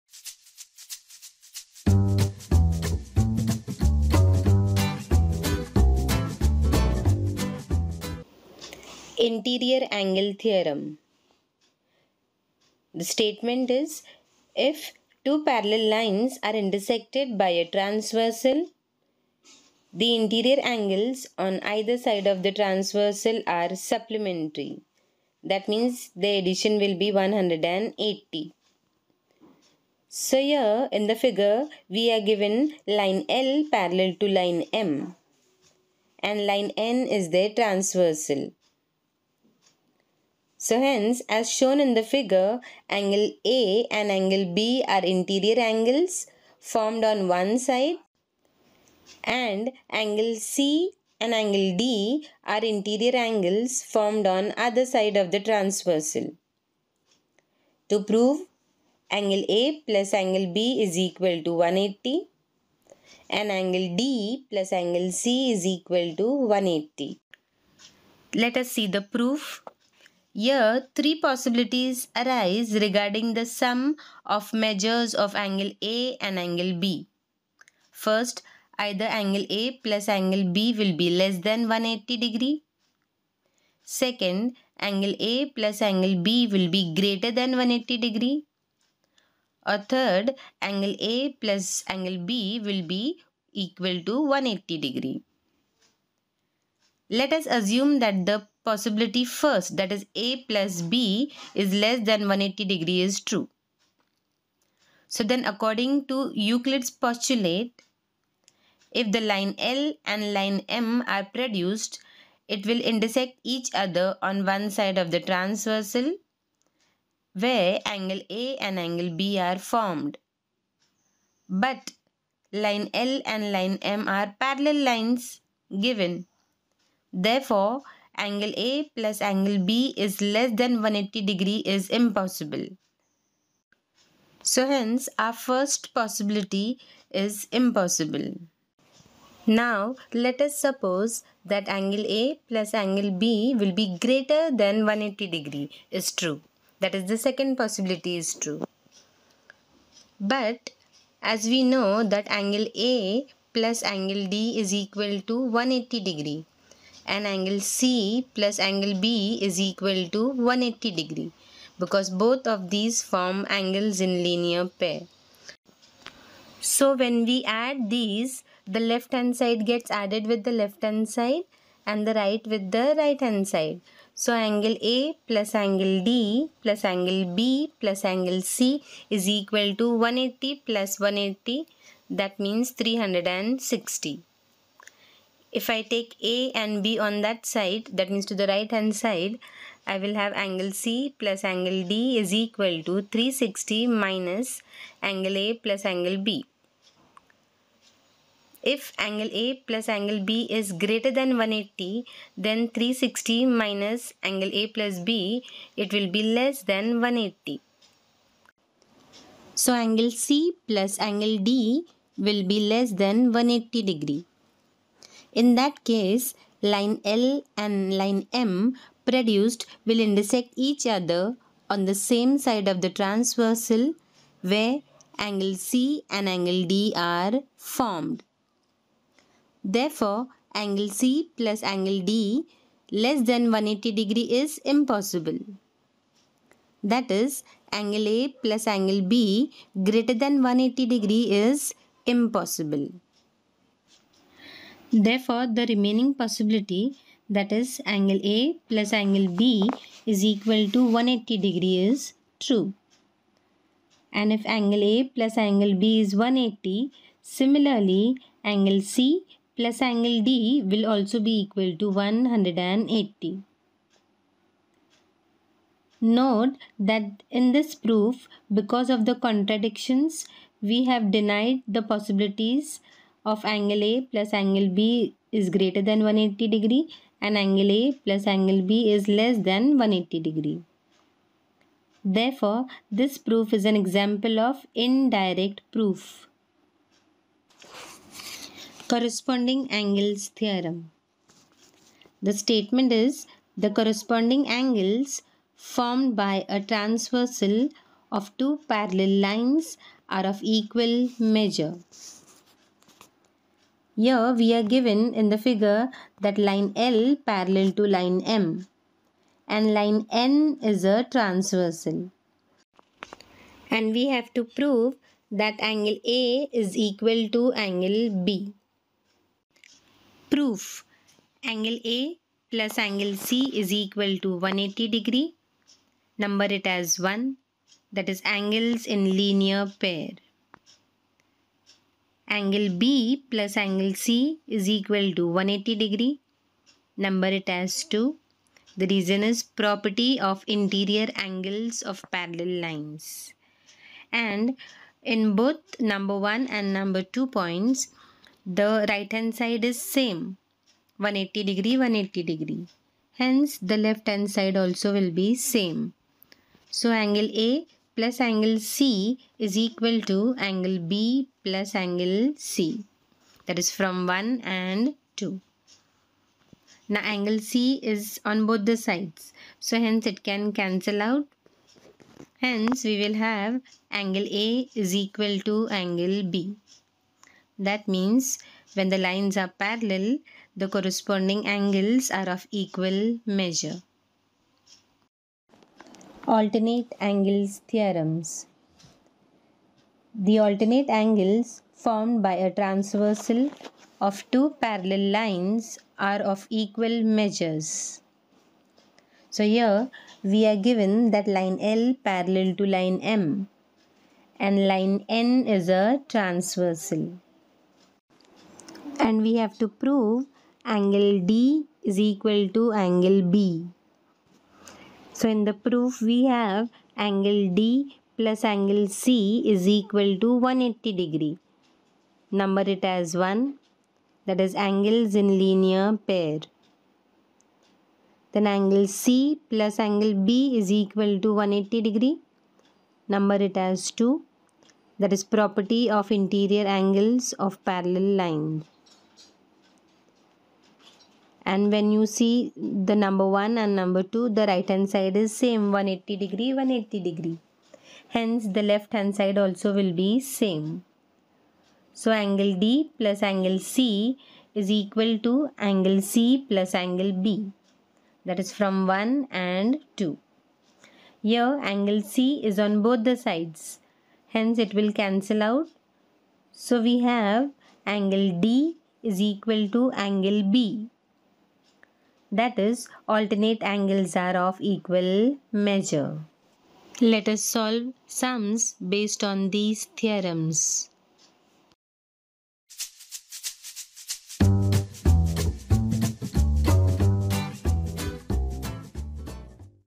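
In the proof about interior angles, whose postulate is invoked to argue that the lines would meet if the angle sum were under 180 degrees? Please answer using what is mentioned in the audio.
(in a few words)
Euclid's postulate.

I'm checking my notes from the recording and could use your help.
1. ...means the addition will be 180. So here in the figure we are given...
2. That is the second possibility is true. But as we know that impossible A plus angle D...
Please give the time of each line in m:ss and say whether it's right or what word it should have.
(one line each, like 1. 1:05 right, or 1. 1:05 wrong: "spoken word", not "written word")
1. 0:25 right
2. 2:26 wrong: "angle", not "impossible".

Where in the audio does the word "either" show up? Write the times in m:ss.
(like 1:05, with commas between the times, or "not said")
0:21, 1:18.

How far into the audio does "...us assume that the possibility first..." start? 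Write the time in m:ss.
1:37.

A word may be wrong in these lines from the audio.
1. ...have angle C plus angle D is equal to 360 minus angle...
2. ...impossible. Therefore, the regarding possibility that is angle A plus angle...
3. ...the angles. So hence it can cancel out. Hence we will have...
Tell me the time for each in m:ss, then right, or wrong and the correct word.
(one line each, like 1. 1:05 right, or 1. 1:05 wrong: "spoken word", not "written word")
1. 3:10 right
2. 4:02 wrong: "remaining", not "regarding"
3. 6:08 wrong: "sides", not "angles".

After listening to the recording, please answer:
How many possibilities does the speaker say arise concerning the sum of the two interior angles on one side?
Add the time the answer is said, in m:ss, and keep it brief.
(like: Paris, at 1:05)
3, at 1:10.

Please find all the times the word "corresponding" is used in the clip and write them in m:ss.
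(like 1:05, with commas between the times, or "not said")
4:48, 4:53, 6:20.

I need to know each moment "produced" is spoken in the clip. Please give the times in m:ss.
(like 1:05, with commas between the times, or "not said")
1:51, 3:39.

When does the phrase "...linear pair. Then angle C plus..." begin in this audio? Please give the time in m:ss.
7:05.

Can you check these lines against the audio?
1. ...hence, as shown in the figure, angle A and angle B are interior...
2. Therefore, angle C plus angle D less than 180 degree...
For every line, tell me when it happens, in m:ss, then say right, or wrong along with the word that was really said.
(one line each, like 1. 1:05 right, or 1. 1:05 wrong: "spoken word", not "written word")
1. 0:40 right
2. 3:49 right.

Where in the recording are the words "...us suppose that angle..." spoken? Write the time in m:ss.
2:20.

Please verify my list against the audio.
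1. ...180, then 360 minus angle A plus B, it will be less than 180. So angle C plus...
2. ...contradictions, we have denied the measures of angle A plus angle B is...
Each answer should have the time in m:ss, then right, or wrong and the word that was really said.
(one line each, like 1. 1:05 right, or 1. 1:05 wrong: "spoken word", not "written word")
1. 3:21 right
2. 4:29 wrong: "possibilities", not "measures".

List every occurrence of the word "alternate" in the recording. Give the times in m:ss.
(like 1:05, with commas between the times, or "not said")
6:26, 6:30, 7:53.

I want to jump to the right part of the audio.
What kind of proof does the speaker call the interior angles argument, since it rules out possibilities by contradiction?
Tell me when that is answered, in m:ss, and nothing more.
4:44.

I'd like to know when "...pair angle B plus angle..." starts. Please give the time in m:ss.
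5:29.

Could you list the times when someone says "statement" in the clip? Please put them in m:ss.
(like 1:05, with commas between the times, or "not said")
0:13, 4:52.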